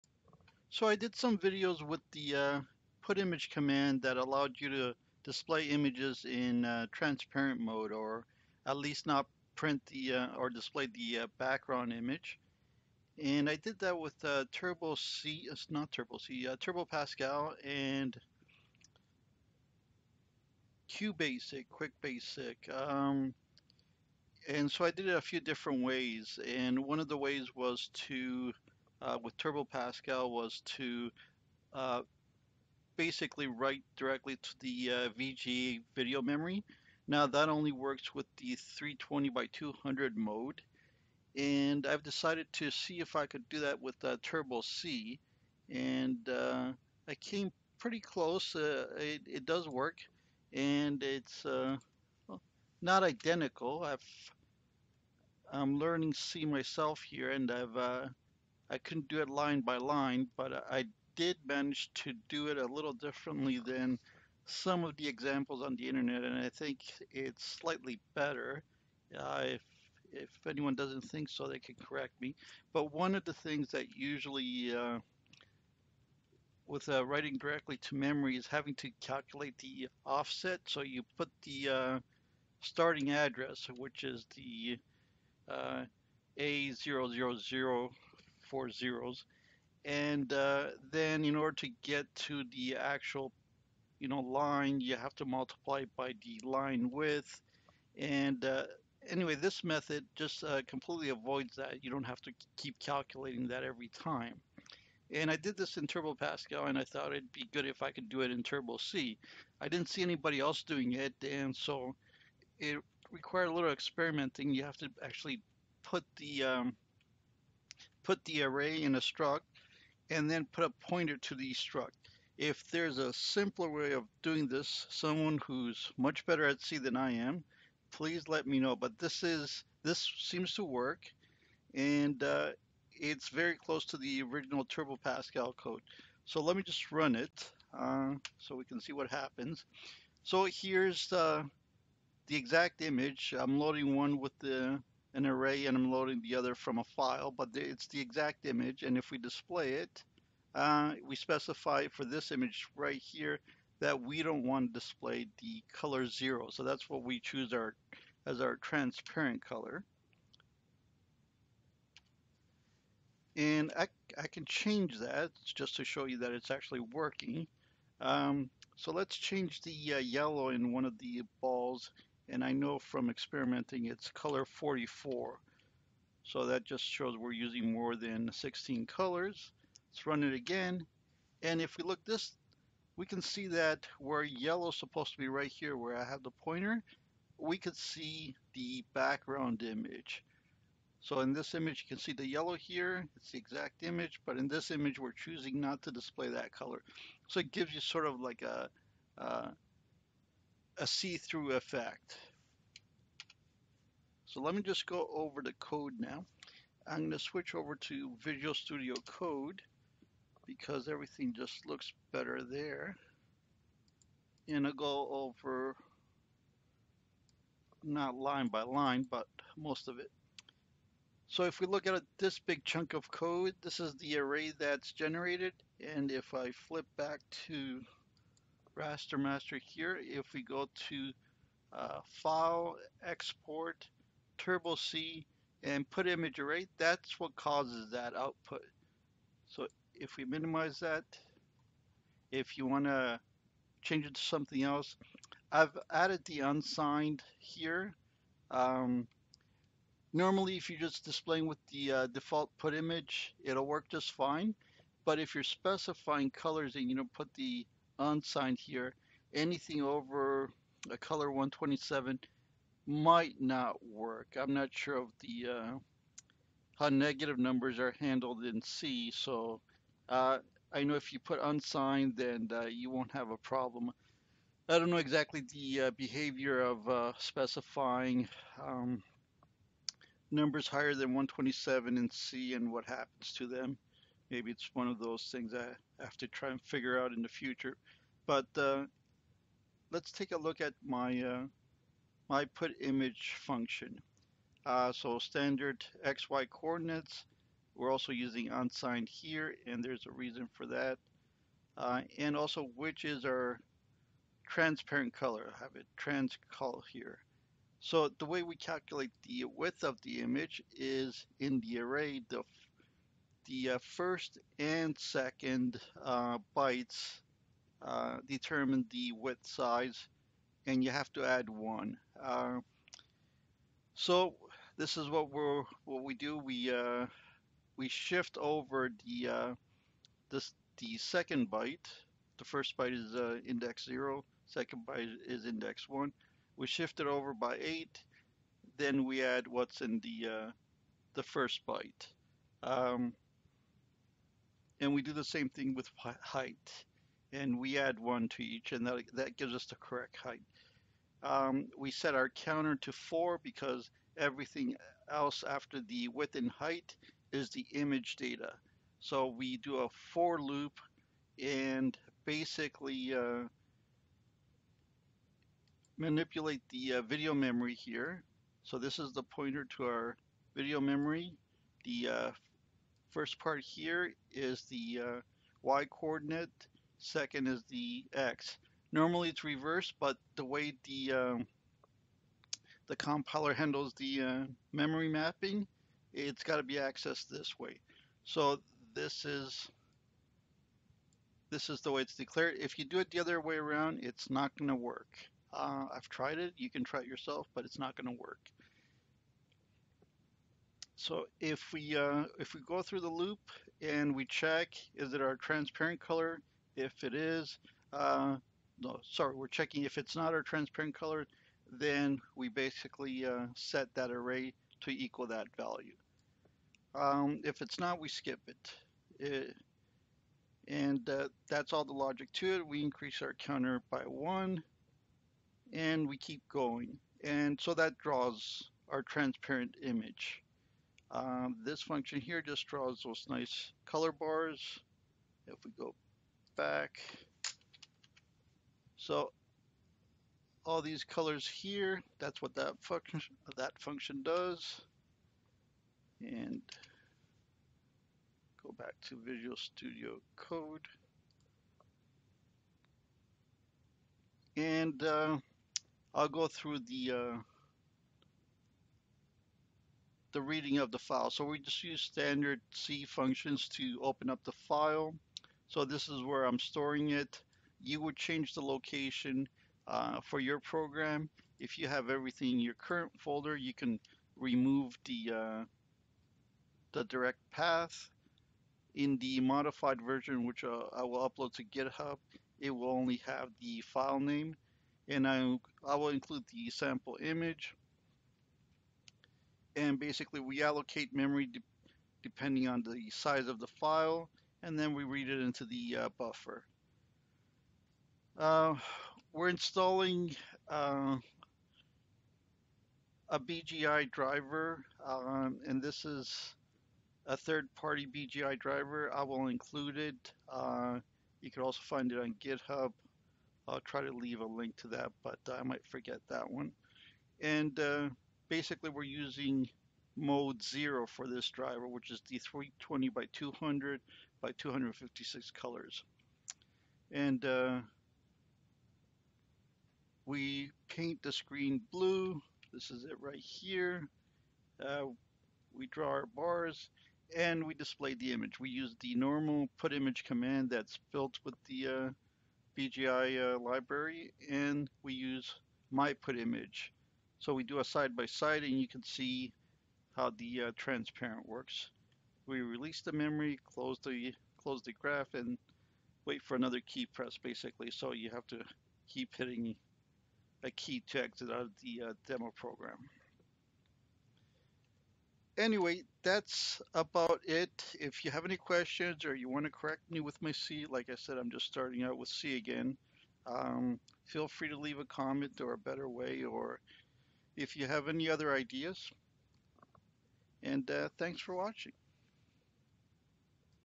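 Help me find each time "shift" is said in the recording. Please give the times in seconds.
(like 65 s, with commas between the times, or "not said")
327 s, 336 s.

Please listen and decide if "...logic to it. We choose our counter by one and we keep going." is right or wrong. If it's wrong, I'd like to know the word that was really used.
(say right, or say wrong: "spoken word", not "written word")
wrong: "increase", not "choose".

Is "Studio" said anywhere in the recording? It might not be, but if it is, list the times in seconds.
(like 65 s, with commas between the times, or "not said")
208 s, 449 s.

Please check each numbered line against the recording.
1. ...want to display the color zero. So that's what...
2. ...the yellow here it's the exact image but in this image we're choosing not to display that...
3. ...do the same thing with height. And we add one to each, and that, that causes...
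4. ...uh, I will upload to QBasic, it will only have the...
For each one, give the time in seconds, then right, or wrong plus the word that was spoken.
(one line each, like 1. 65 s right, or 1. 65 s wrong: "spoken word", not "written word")
1. 154 s right
2. 192 s right
3. 345 s wrong: "gives", not "causes"
4. 480 s wrong: "GitHub", not "QBasic".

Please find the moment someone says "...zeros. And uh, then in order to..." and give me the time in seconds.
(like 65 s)
88 s.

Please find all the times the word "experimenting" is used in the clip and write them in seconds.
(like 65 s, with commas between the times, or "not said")
113 s, 173 s.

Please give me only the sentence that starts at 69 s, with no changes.
Uh, if if anyone doesn't think so, they can correct me.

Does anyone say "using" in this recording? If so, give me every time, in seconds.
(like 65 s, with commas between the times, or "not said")
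177 s, 298 s, 519 s.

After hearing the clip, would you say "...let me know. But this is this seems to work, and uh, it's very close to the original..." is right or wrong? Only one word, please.
right.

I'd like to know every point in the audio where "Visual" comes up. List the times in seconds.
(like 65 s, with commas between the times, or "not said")
208 s, 449 s.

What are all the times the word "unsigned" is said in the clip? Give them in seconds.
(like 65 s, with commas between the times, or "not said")
246 s, 258 s, 271 s, 298 s.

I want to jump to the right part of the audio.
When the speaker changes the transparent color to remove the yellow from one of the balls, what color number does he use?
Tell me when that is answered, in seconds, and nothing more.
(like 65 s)
174 s.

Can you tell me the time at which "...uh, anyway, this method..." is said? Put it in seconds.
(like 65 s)
98 s.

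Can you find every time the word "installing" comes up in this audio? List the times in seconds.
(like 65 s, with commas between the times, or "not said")
499 s.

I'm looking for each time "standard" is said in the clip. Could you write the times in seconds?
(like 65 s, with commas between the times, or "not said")
295 s, 462 s.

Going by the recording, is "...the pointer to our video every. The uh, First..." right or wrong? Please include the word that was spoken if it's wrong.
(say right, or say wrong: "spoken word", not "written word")
wrong: "memory", not "every".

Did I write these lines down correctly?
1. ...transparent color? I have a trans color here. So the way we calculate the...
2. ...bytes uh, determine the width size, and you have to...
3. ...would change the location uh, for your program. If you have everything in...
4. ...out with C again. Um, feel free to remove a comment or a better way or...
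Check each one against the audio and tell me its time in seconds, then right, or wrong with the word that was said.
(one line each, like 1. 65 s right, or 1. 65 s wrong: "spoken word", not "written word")
1. 304 s right
2. 316 s right
3. 468 s right
4. 572 s wrong: "leave", not "remove".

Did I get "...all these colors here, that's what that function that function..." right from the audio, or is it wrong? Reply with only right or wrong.
right.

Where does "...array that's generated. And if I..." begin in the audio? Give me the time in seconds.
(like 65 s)
224 s.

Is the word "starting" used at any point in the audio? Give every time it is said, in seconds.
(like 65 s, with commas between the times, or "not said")
82 s, 571 s.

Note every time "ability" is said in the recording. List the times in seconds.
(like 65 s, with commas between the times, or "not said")
not said.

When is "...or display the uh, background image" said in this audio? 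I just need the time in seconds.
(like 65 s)
10 s.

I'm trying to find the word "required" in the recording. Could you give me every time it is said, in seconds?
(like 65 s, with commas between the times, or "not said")
113 s.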